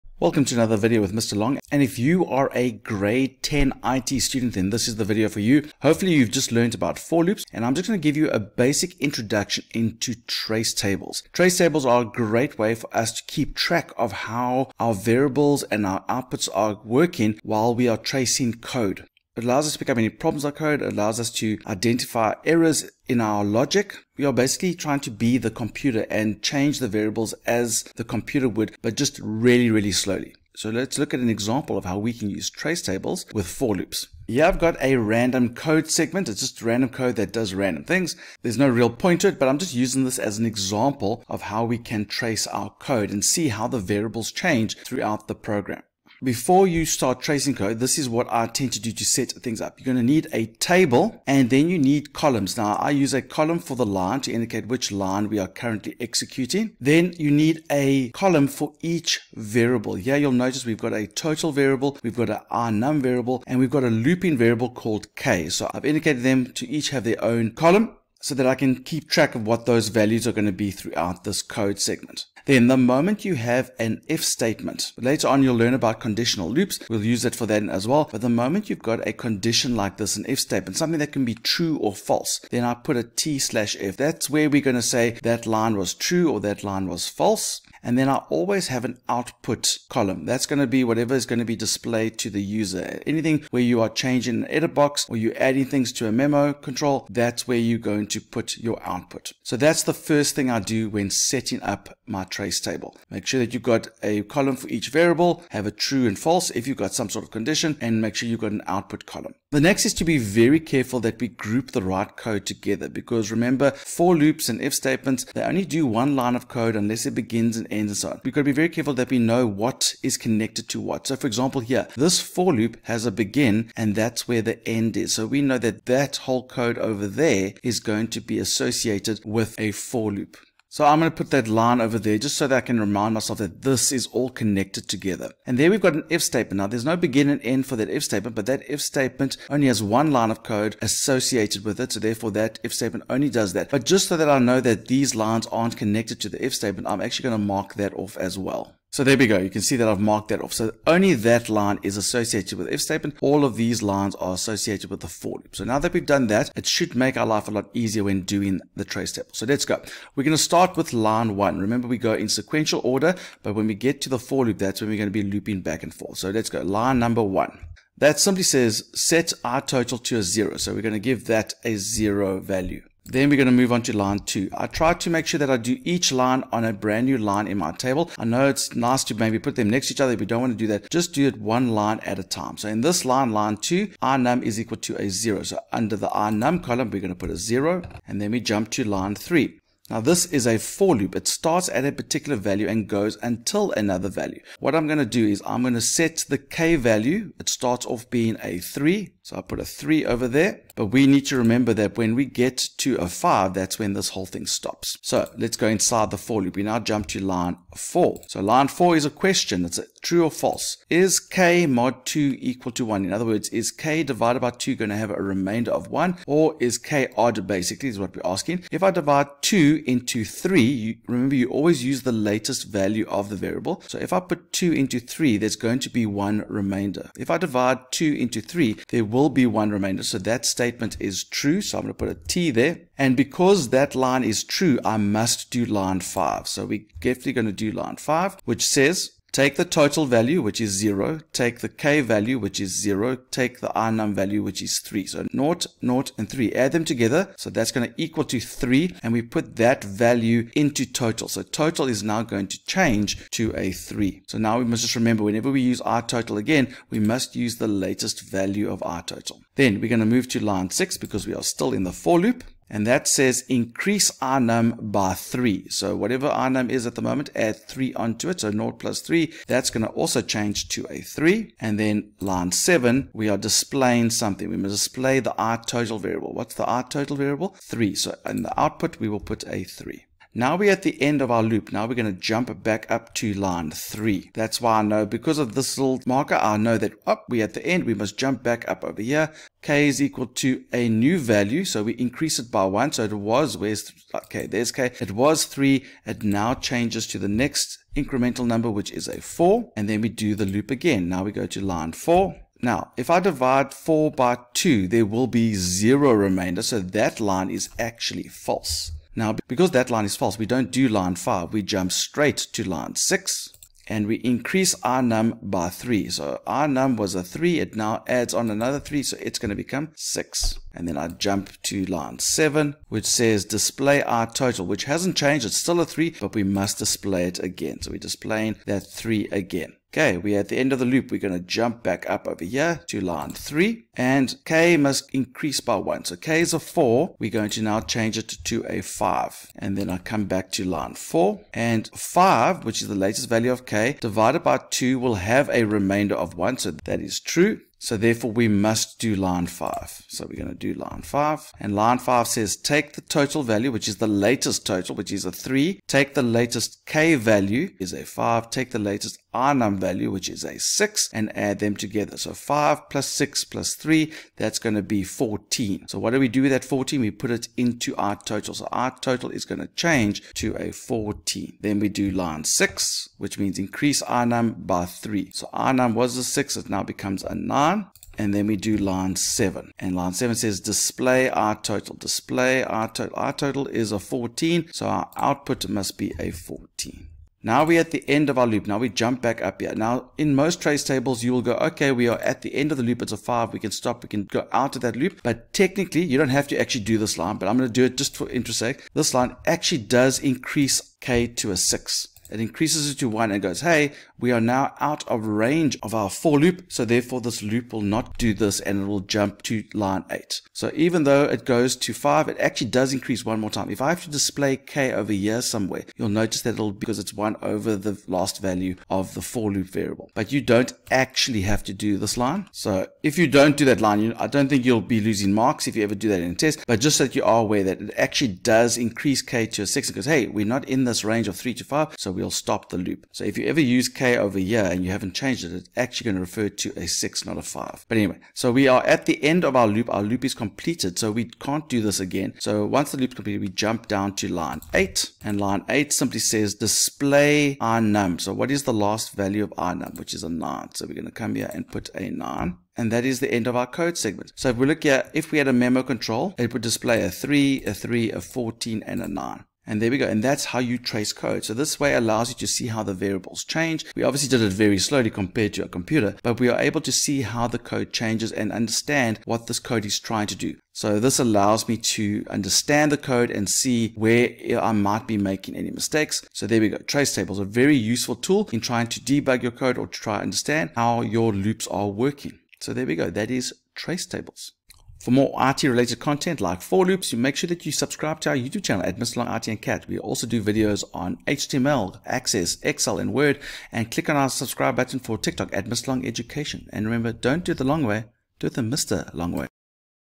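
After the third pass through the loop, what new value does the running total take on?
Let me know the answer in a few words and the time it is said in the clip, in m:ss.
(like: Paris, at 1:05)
14, at 6:08.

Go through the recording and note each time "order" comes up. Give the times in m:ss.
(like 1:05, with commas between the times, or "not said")
2:42.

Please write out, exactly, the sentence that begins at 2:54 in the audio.
I try to make sure that I do each line on a brand new line in my table.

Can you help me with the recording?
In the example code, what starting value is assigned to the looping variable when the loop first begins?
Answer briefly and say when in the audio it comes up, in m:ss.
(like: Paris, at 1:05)
3, at 3:17.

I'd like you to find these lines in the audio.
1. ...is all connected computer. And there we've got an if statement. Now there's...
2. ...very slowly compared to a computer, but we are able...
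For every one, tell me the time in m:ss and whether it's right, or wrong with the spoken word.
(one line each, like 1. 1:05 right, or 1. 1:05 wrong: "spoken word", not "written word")
1. 2:13 wrong: "together", not "computer"
2. 7:44 right.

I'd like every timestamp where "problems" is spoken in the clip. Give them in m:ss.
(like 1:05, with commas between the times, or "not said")
0:20.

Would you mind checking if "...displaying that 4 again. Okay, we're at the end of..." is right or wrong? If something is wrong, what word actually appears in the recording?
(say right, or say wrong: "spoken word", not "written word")
wrong: "3", not "4".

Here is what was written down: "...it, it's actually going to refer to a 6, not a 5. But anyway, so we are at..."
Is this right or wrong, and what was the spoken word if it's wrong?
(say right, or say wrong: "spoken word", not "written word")
right.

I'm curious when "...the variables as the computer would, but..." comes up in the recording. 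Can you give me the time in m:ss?
0:26.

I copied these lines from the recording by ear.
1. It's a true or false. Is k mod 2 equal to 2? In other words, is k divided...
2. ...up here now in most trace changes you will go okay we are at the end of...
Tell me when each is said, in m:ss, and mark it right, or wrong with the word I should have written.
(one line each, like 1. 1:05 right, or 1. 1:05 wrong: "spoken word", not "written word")
1. 3:29 wrong: "1", not "2"
2. 6:29 wrong: "tables", not "changes".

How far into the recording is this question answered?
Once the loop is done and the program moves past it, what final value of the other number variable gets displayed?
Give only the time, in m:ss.
7:29.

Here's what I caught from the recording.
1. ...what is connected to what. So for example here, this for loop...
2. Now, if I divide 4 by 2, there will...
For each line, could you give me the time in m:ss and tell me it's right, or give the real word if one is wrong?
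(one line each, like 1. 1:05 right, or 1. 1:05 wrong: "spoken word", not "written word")
1. 1:59 right
2. 5:02 right.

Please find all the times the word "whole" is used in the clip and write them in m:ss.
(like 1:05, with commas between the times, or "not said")
2:06, 3:24.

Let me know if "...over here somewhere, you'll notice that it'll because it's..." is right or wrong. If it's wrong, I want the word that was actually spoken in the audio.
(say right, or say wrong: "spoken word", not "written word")
right.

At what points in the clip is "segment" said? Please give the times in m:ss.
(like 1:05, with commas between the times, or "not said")
0:35, 1:11, 7:33.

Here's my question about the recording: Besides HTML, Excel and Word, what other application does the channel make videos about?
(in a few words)
Access.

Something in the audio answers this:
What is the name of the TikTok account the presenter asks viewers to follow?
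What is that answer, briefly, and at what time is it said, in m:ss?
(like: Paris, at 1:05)
Mr. Long Education, at 8:15.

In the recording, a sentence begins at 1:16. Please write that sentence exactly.
We'll use that for that as well.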